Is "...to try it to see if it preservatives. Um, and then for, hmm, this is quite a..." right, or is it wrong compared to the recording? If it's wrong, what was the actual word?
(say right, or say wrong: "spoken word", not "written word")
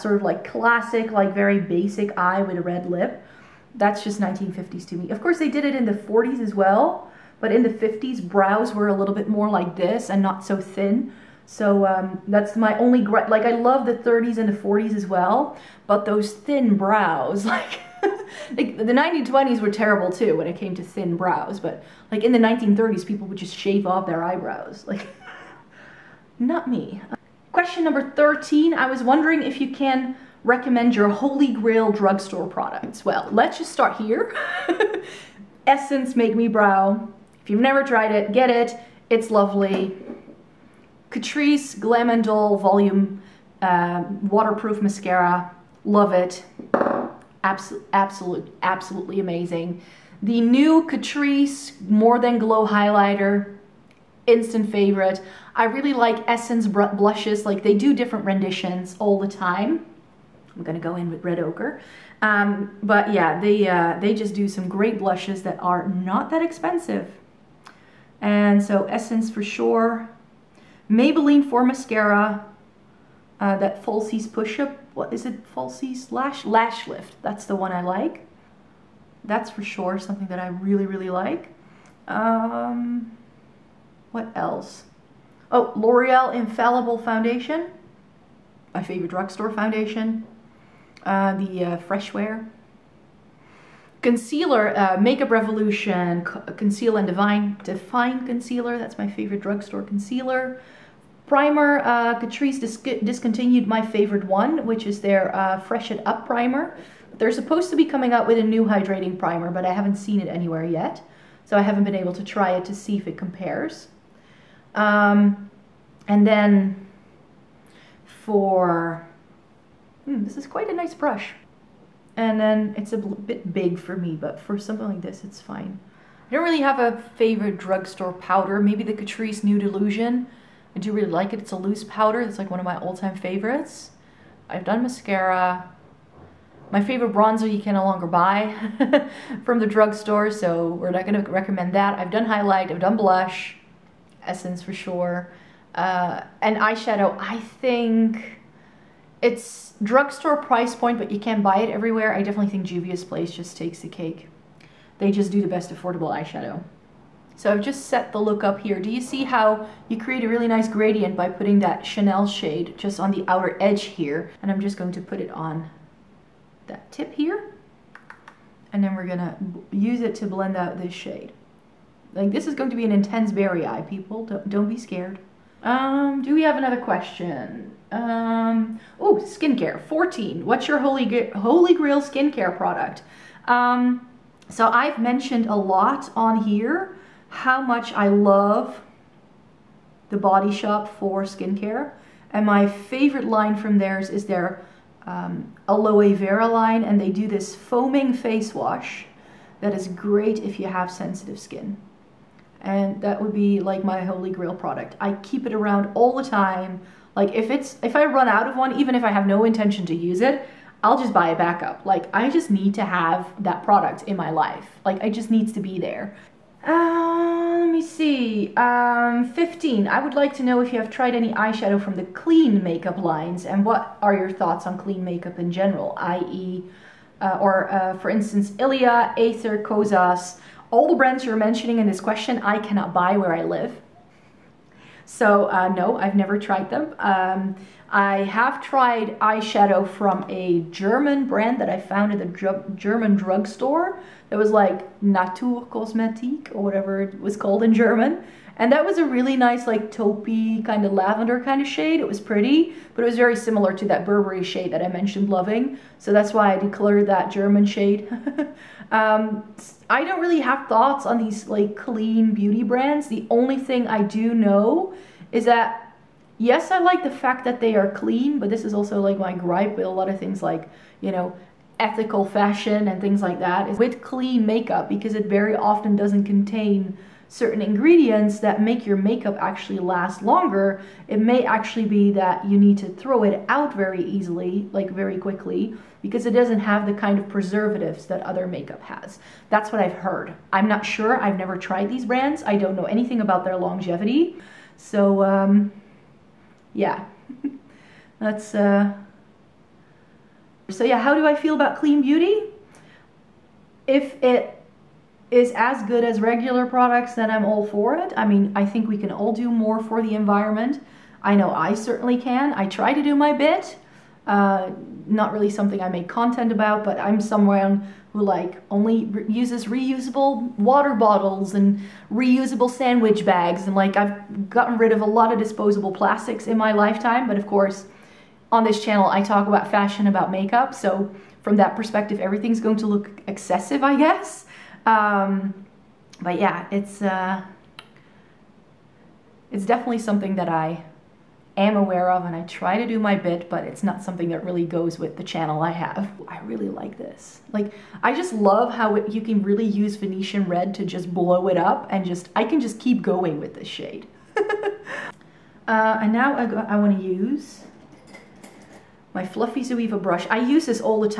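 wrong: "compares", not "preservatives".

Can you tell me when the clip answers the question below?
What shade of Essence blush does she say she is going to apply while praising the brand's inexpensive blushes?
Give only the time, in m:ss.
1:01.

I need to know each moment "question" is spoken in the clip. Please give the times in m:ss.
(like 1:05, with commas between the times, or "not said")
0:27, 2:56, 3:52.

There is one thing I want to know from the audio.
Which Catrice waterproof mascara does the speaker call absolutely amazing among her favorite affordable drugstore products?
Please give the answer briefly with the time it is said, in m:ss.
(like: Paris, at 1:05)
Glam and Doll Volume, at 0:41.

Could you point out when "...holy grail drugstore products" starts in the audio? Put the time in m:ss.
0:31.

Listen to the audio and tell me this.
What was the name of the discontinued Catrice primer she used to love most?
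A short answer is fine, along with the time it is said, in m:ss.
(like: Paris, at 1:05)
Fresh It Up, at 1:45.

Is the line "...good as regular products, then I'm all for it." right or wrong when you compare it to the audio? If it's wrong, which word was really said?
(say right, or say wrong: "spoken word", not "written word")
right.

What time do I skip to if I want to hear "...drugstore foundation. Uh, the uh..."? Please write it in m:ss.
1:29.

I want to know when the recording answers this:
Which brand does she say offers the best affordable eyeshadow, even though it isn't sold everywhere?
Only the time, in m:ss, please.
2:32.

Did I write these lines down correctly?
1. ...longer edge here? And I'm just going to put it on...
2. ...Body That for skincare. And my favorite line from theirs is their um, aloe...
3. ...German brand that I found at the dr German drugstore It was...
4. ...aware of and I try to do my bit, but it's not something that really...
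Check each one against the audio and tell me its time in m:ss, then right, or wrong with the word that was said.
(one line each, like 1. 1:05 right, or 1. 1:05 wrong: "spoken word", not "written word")
1. 2:43 wrong: "outer", not "longer"
2. 3:10 wrong: "Shop", not "That"
3. 4:00 right
4. 5:41 right.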